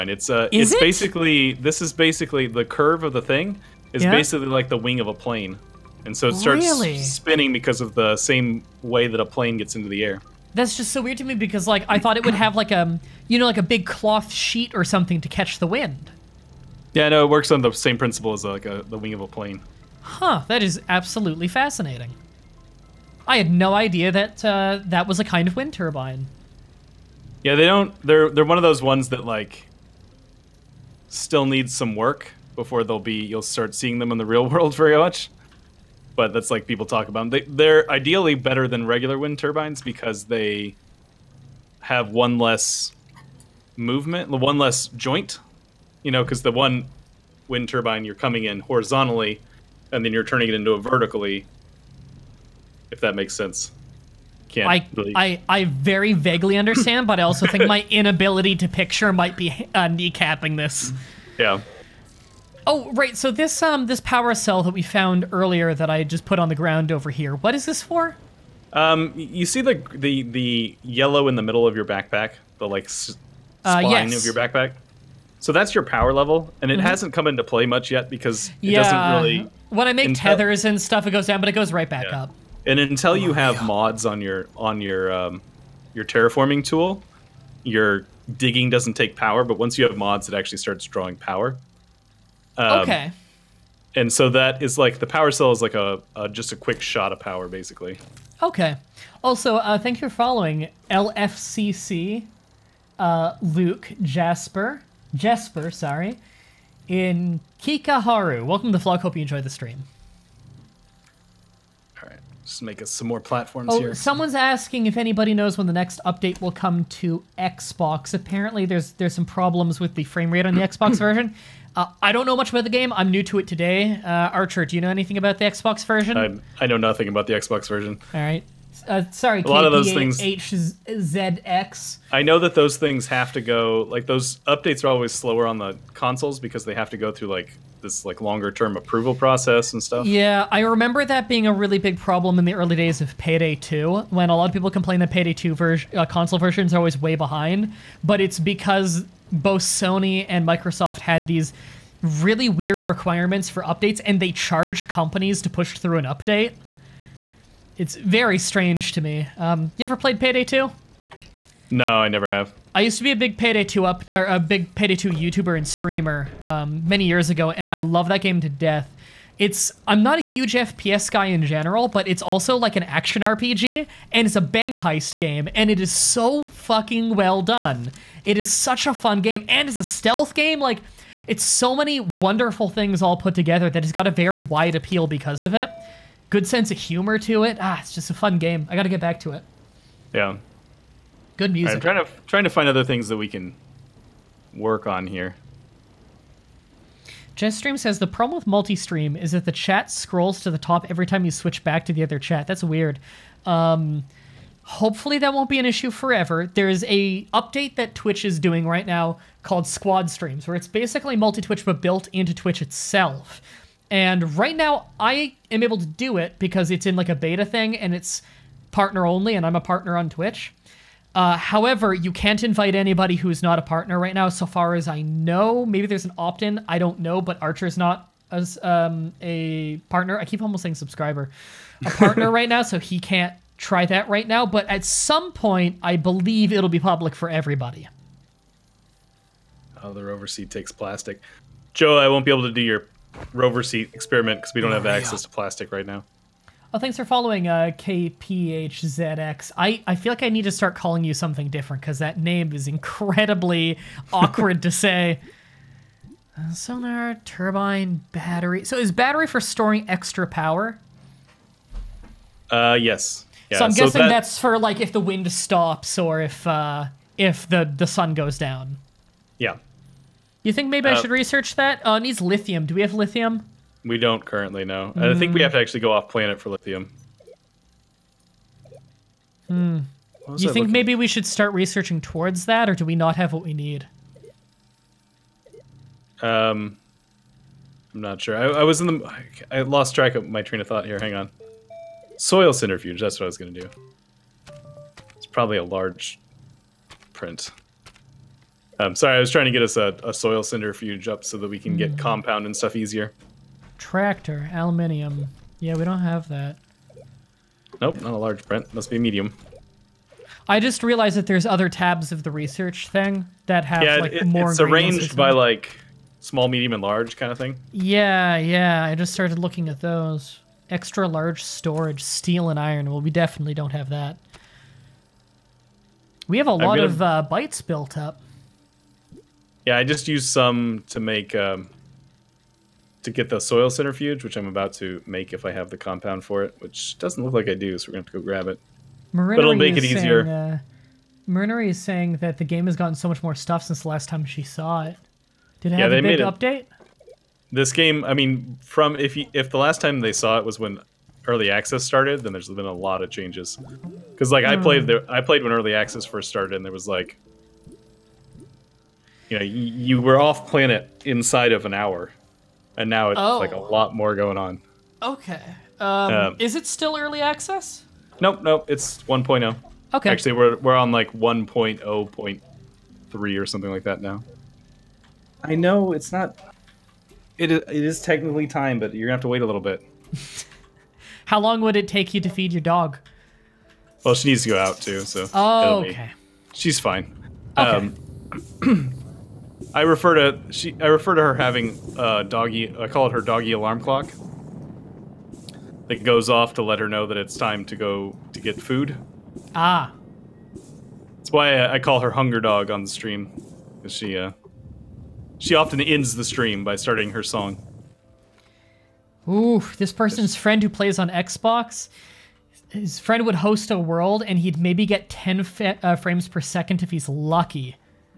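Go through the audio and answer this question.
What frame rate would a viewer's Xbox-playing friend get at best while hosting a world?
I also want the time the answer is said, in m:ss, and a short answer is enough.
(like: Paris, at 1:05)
10 frames per second, at 6:55.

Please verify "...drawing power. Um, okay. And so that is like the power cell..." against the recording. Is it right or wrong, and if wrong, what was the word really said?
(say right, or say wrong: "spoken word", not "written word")
right.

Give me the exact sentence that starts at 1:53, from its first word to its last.
Someone's asking if anybody knows when the next update will come to Xbox.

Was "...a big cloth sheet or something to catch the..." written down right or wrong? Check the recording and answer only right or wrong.
right.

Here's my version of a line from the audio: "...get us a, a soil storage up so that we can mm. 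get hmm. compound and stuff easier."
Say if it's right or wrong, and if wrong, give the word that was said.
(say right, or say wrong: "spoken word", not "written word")
wrong: "centrifuge", not "storage".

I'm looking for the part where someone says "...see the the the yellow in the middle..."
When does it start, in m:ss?
1:09.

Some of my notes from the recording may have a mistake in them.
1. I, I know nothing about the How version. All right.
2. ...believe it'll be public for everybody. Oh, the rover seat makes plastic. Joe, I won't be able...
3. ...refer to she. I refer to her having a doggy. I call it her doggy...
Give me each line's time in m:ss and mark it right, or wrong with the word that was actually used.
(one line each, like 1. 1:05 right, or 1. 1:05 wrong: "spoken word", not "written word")
1. 2:06 wrong: "Xbox", not "How"
2. 3:55 wrong: "takes", not "makes"
3. 6:29 right.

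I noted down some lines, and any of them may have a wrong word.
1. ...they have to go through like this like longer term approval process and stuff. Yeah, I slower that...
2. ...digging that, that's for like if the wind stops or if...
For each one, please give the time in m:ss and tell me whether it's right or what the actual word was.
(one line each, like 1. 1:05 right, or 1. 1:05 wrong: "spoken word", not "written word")
1. 2:16 wrong: "remember", not "slower"
2. 4:23 wrong: "guessing", not "digging".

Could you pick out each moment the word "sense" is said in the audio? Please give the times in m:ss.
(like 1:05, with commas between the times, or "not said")
0:53, 3:06.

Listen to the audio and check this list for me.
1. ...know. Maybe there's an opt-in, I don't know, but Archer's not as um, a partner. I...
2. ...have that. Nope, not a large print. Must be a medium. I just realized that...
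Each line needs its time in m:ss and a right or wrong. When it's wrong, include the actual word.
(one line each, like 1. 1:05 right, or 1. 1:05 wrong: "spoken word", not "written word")
1. 3:45 right
2. 5:05 right.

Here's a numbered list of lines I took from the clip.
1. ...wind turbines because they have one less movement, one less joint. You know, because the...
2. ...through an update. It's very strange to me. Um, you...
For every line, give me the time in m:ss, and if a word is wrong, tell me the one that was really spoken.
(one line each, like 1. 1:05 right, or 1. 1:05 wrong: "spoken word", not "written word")
1. 0:39 right
2. 2:35 right.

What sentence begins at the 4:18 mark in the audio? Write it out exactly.
So is battery for storing extra power?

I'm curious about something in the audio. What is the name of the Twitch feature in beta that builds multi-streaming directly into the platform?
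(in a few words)
Squad Streams.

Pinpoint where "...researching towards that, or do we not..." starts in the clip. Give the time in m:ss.
4:41.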